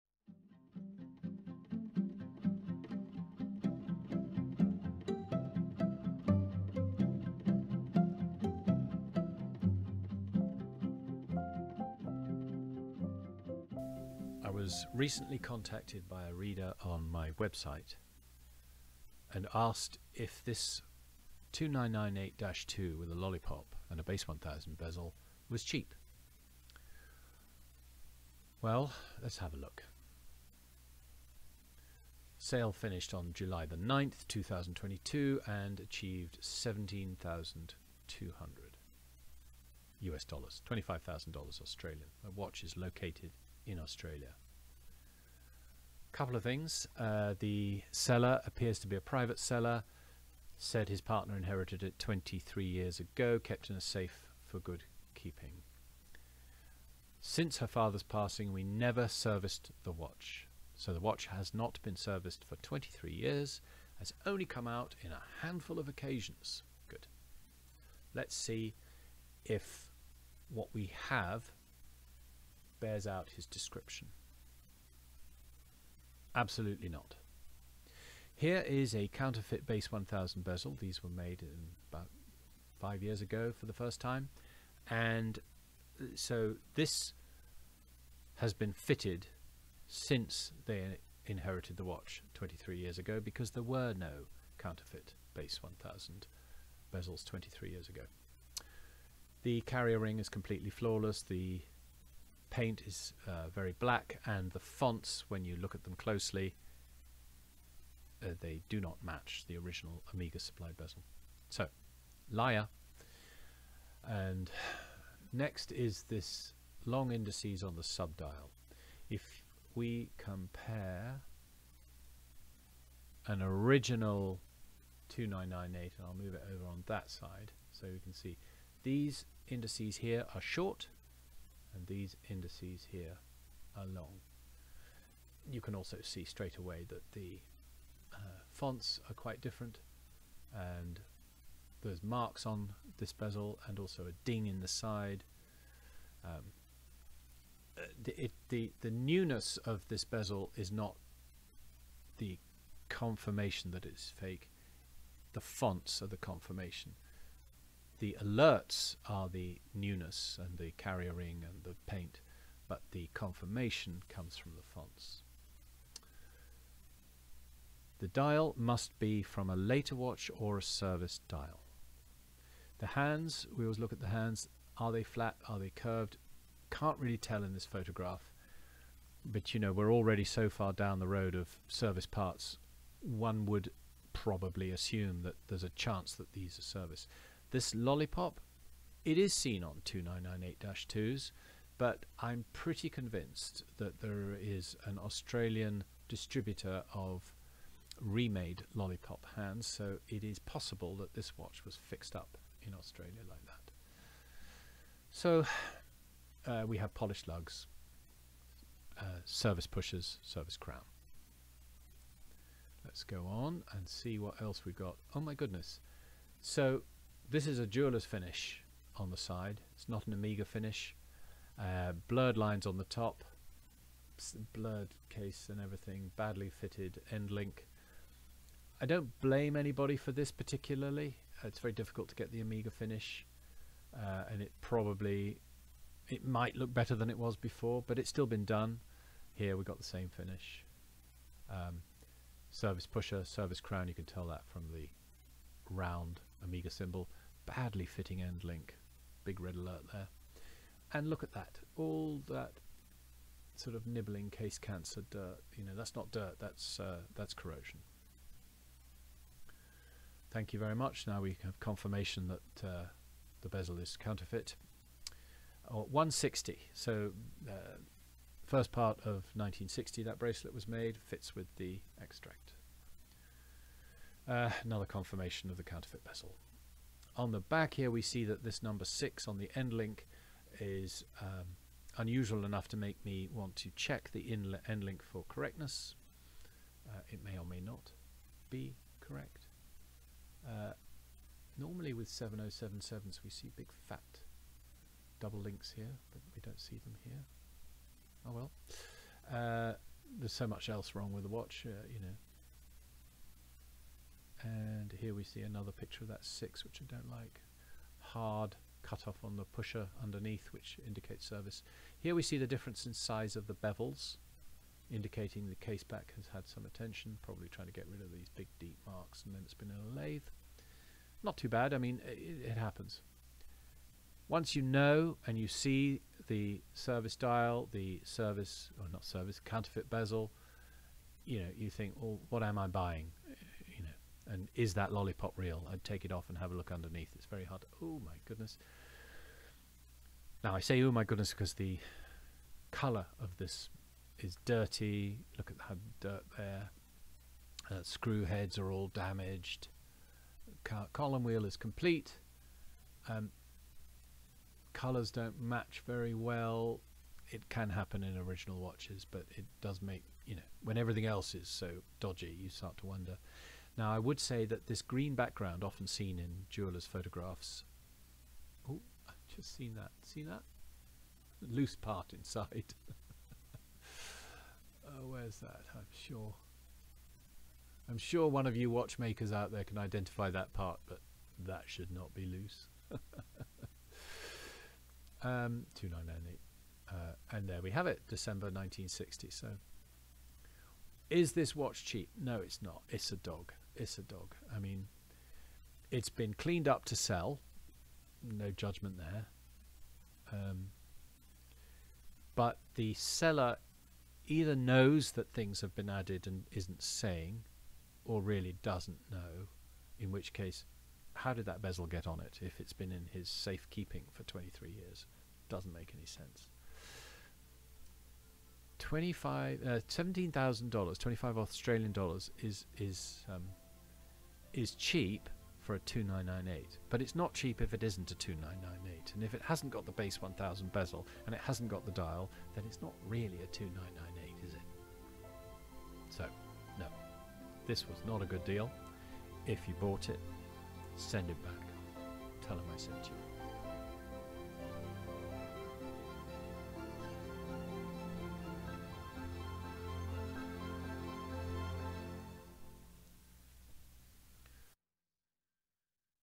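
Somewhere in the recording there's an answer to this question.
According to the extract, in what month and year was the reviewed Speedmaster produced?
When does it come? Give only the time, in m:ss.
6:28.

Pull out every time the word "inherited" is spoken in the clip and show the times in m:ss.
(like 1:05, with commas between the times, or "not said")
0:51, 1:31.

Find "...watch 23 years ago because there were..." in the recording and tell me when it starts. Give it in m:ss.
1:31.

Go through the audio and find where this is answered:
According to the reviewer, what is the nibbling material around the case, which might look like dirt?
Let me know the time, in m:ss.
4:17.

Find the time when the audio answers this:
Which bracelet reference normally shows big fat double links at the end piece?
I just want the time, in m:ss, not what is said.
4:52.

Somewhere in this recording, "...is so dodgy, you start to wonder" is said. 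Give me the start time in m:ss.
6:01.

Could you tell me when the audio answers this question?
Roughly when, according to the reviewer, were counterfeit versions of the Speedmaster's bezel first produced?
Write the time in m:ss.
1:21.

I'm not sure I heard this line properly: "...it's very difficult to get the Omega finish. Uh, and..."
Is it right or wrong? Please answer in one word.
right.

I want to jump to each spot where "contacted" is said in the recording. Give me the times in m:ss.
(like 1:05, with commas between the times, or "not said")
0:15.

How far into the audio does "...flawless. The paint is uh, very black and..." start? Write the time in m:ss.
1:40.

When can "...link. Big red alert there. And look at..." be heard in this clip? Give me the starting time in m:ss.
4:08.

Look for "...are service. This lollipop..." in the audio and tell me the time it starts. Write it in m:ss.
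3:06.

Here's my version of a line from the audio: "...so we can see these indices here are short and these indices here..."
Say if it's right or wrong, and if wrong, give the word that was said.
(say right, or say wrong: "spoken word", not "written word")
right.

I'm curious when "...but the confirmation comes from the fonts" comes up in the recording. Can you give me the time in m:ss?
2:42.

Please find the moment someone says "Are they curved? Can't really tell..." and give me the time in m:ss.
2:55.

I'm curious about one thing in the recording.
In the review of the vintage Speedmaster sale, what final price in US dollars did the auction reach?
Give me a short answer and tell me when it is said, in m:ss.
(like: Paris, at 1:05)
$17,200, at 0:36.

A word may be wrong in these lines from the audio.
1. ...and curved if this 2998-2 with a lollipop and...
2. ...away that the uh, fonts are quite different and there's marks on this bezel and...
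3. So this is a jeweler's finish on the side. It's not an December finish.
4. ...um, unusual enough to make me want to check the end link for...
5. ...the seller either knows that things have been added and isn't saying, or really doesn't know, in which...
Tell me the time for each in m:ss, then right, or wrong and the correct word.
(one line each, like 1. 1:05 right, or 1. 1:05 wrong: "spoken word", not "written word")
1. 0:19 wrong: "asked", not "curved"
2. 2:16 right
3. 3:36 wrong: "Omega", not "December"
4. 4:41 right
5. 6:42 right.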